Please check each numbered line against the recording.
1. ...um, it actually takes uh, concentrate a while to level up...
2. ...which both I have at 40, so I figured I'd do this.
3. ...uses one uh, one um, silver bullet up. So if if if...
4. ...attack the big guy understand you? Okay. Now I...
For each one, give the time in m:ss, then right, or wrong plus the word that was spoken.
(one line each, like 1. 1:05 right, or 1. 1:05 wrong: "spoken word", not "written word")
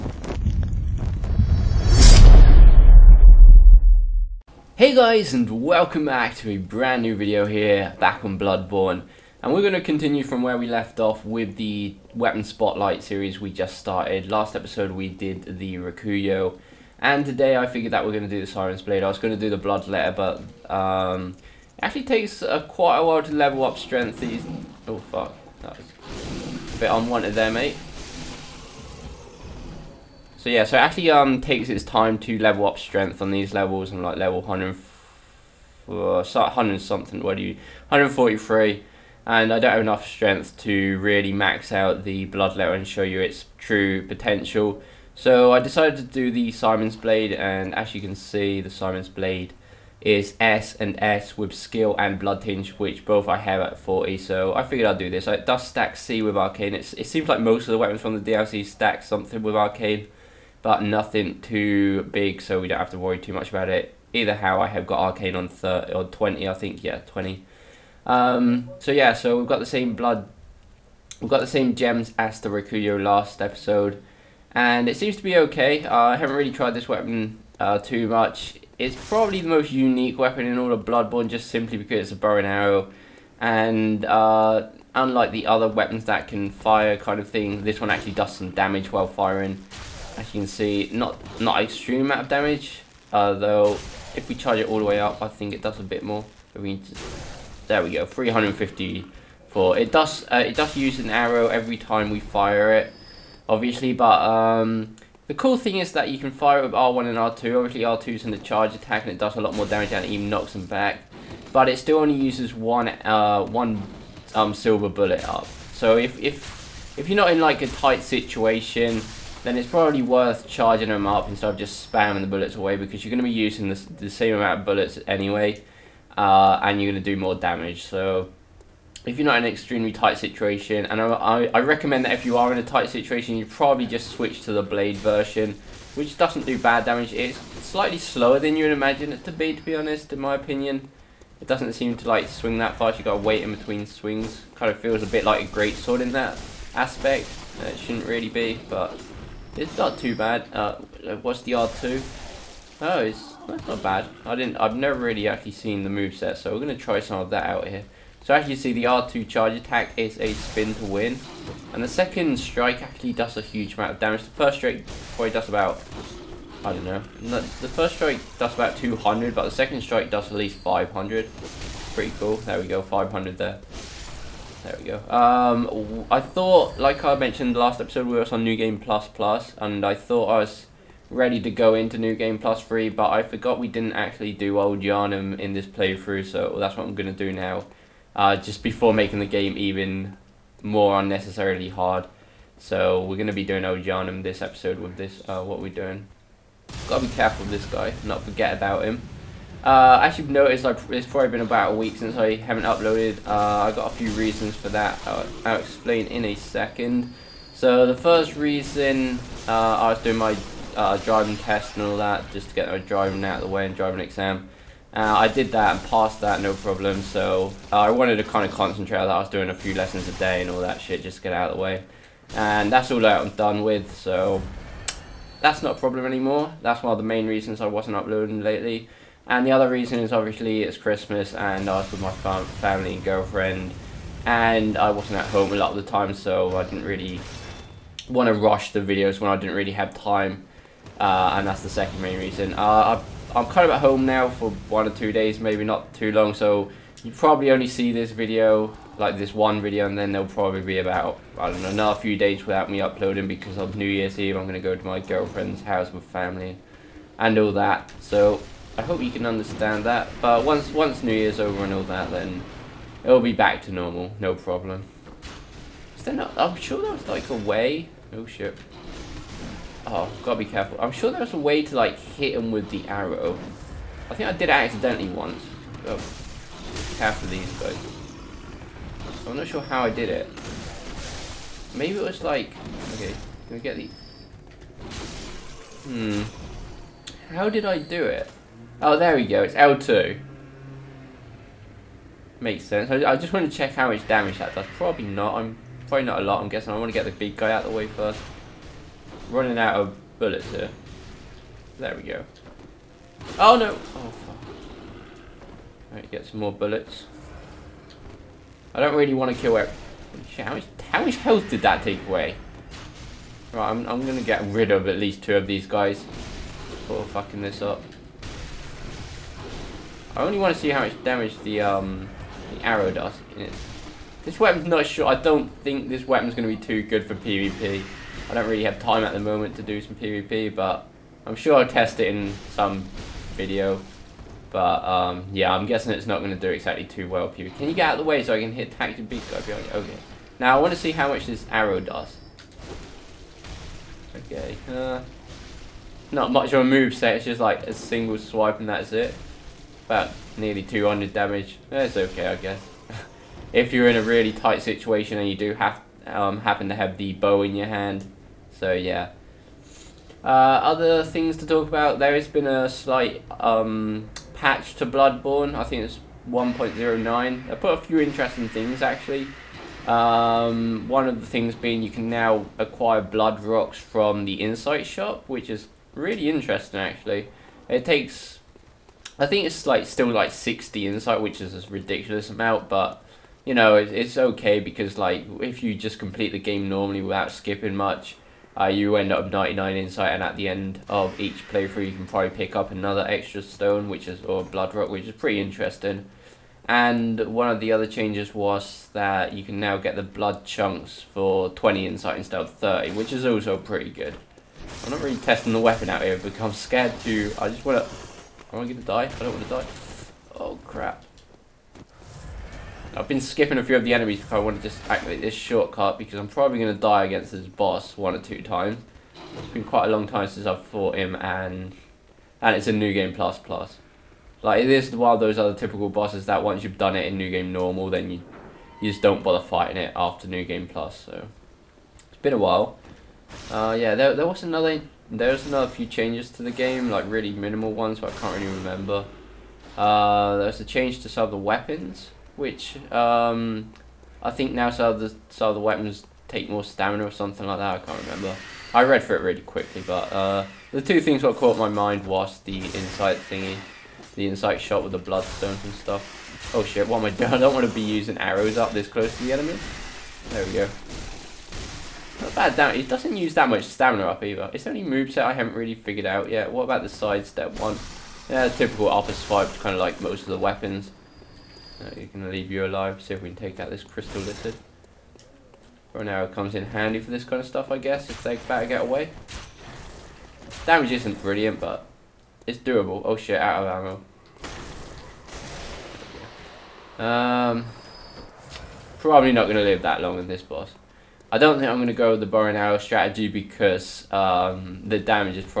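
1. 0:20 wrong: "quite", not "concentrate"
2. 0:52 right
3. 1:52 right
4. 5:38 wrong: "behind", not "understand".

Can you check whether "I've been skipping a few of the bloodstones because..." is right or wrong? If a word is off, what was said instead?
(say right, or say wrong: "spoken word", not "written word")
wrong: "enemies", not "bloodstones".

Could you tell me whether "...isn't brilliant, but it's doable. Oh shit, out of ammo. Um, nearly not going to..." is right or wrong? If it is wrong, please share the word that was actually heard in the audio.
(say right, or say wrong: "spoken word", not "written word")
wrong: "probably", not "nearly".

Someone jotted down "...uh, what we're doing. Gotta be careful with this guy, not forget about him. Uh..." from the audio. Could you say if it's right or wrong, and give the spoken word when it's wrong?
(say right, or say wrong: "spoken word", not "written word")
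right.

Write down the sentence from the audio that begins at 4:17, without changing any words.
So I hope you can understand that.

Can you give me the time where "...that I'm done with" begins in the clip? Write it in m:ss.
3:43.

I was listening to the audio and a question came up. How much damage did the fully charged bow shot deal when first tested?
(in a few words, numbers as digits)
354.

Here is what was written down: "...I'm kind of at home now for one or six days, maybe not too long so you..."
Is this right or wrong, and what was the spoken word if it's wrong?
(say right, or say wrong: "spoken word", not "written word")
wrong: "two", not "six".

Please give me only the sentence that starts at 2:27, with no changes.
It shouldn't really be, but it's not too bad.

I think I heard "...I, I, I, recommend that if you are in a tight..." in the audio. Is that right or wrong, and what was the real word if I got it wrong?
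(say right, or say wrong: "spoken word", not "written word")
right.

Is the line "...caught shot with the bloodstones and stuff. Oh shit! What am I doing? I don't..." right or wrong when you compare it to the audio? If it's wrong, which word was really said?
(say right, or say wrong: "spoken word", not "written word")
wrong: "insight", not "caught".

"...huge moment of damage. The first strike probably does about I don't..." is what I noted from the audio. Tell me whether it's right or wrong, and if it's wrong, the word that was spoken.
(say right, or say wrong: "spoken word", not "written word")
wrong: "amount", not "moment".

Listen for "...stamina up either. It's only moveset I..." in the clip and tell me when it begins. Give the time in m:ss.
7:43.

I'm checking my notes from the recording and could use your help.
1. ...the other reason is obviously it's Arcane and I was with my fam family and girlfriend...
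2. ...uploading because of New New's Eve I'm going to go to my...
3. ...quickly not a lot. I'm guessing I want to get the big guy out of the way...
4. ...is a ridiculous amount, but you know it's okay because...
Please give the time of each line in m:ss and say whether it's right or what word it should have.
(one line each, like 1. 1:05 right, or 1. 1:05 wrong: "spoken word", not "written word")
1. 3:49 wrong: "Christmas", not "Arcane"
2. 4:12 wrong: "Year", not "New"
3. 4:55 wrong: "probably", not "quickly"
4. 6:21 right.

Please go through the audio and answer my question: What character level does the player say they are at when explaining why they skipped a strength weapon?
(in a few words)
143.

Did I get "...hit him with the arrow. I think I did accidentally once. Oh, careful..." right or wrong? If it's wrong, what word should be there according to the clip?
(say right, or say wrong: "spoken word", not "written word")
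right.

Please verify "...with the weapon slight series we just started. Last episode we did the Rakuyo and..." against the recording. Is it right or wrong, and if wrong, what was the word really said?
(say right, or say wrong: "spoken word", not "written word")
wrong: "spotlight", not "slight".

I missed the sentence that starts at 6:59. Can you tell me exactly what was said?
It's been quite a long time since I've fought him and and it's a new game plus plus.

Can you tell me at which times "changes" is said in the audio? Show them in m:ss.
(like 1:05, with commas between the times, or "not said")
6:37, 7:15, 7:20.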